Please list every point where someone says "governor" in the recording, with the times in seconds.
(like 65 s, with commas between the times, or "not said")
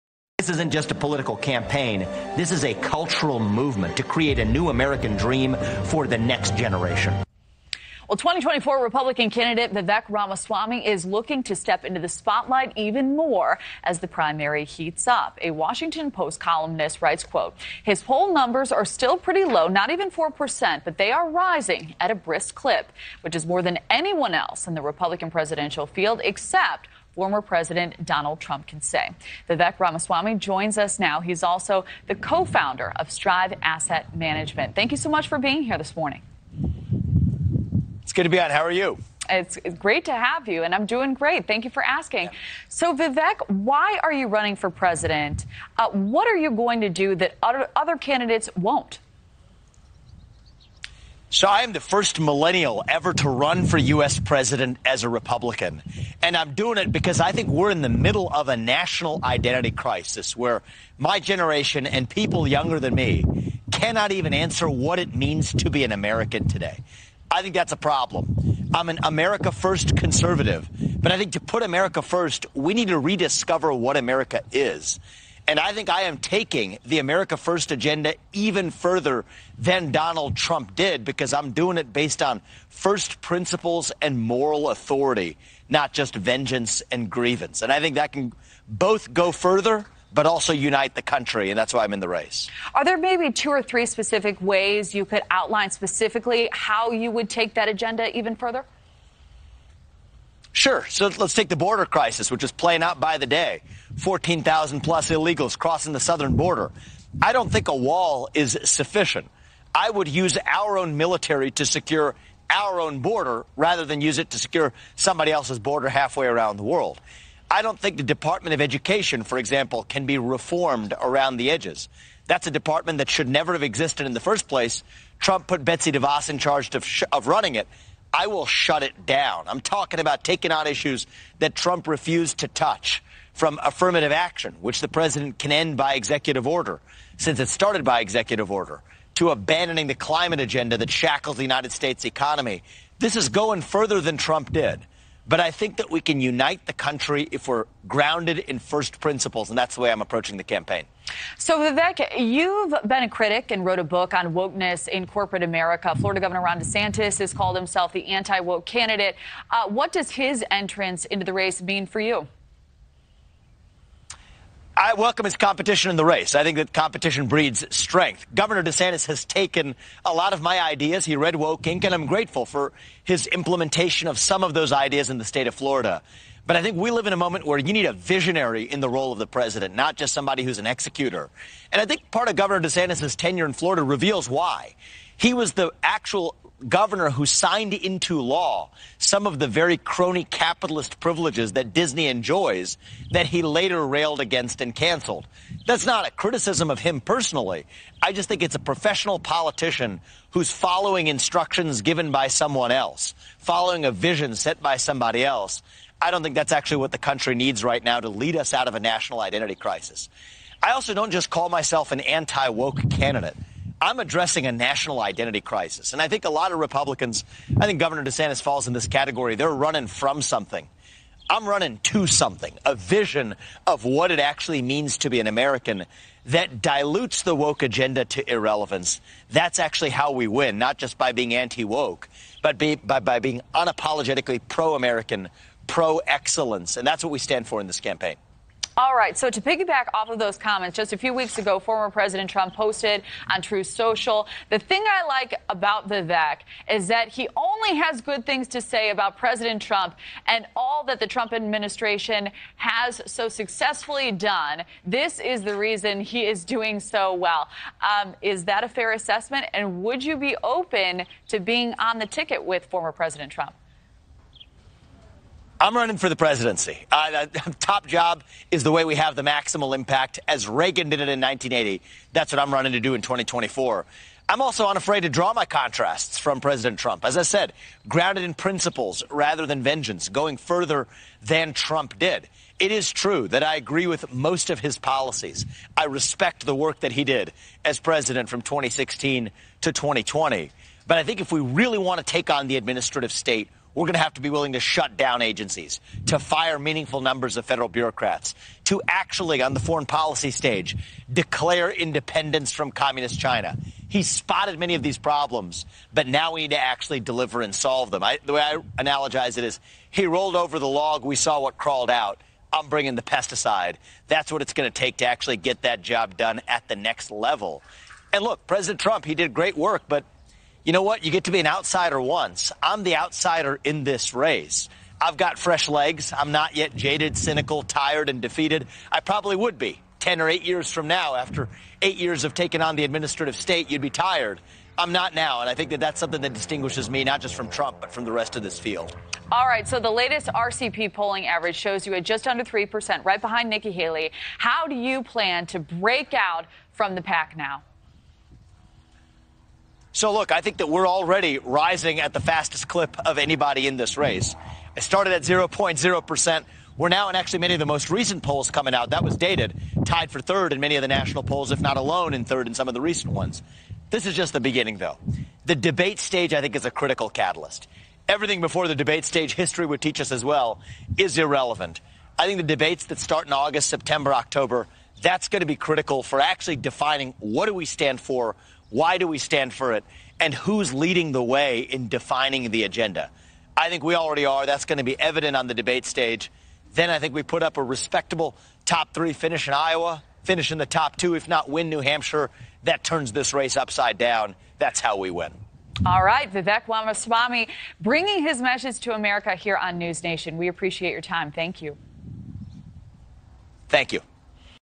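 156 s, 168 s, 182 s, 186 s, 217 s.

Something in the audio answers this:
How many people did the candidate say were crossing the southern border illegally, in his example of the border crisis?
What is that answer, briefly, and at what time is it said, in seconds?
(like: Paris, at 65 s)
14,000 plus, at 103 s.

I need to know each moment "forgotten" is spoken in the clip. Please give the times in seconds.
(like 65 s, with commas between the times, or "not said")
not said.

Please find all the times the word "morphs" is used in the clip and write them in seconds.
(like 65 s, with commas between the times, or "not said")
not said.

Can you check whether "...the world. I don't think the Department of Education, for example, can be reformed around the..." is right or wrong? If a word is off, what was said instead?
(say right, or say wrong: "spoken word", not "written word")
right.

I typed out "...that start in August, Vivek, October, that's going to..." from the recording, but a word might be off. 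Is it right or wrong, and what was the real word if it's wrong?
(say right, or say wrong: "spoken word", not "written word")
wrong: "September", not "Vivek".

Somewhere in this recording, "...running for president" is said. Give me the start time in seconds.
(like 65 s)
44 s.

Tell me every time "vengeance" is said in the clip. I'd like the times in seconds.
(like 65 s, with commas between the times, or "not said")
86 s, 279 s.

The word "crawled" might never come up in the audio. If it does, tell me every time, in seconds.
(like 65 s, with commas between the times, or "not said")
311 s.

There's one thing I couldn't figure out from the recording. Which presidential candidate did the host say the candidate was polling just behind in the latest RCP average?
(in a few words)
Nikki Haley.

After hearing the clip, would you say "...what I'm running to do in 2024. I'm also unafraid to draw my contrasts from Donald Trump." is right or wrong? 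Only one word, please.
wrong.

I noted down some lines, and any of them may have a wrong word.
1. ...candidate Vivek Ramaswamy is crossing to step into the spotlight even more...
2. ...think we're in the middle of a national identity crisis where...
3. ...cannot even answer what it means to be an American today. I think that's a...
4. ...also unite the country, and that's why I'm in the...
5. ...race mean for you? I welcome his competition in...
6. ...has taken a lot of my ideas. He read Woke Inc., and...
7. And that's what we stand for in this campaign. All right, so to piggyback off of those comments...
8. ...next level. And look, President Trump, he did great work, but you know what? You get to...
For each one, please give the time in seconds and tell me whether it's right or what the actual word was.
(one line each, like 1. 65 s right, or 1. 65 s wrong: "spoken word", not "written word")
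1. 9 s wrong: "looking", not "crossing"
2. 57 s right
3. 63 s right
4. 90 s right
5. 161 s right
6. 169 s right
7. 236 s right
8. 316 s right.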